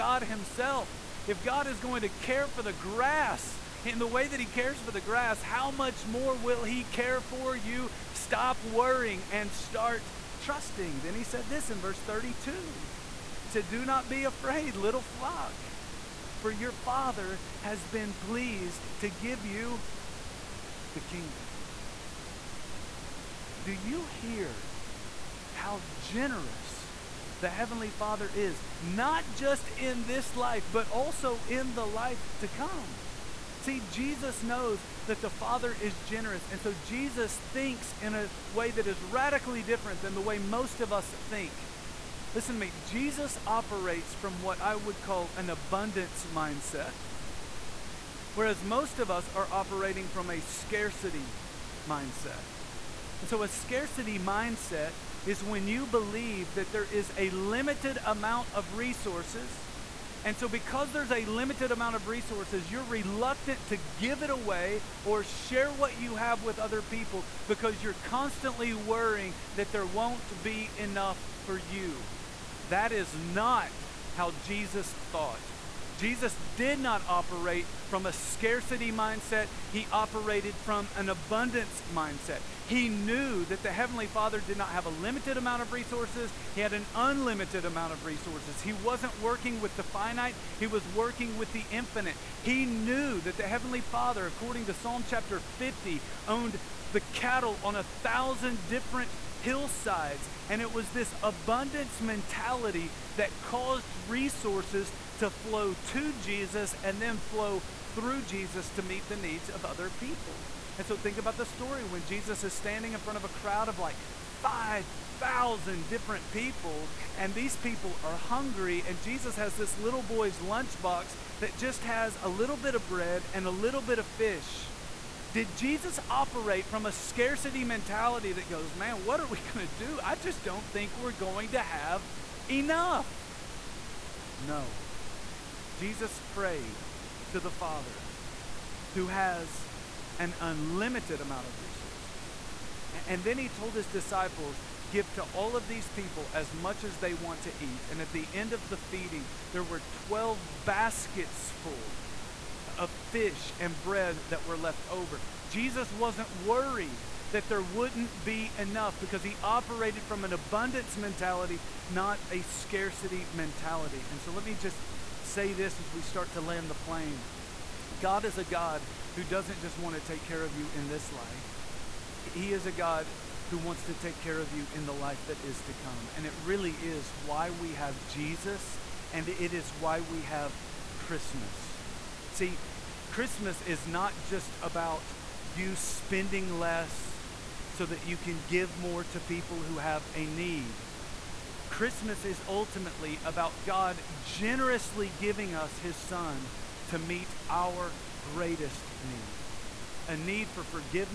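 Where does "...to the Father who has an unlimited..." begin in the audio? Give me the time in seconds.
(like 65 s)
137 s.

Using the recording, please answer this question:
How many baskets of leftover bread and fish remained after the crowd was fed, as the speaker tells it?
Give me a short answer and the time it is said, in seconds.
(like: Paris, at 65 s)
12, at 149 s.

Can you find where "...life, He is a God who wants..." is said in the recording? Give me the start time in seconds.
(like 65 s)
171 s.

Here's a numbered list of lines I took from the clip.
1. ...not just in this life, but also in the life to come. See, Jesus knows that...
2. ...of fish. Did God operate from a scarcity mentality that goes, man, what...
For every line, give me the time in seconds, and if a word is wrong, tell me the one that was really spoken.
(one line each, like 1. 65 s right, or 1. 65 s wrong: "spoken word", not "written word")
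1. 28 s right
2. 123 s wrong: "Jesus", not "God".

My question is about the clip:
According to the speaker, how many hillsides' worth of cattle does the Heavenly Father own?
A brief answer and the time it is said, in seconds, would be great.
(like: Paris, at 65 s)
1,000, at 97 s.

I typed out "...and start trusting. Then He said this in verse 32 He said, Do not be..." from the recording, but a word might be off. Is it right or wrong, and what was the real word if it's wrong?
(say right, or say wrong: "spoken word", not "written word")
right.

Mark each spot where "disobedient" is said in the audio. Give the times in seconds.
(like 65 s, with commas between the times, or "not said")
not said.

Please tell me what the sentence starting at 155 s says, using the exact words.
Jesus wasn't worried that there wouldn't be enough because he operated from an abundance mentality, not a scarcity mentality.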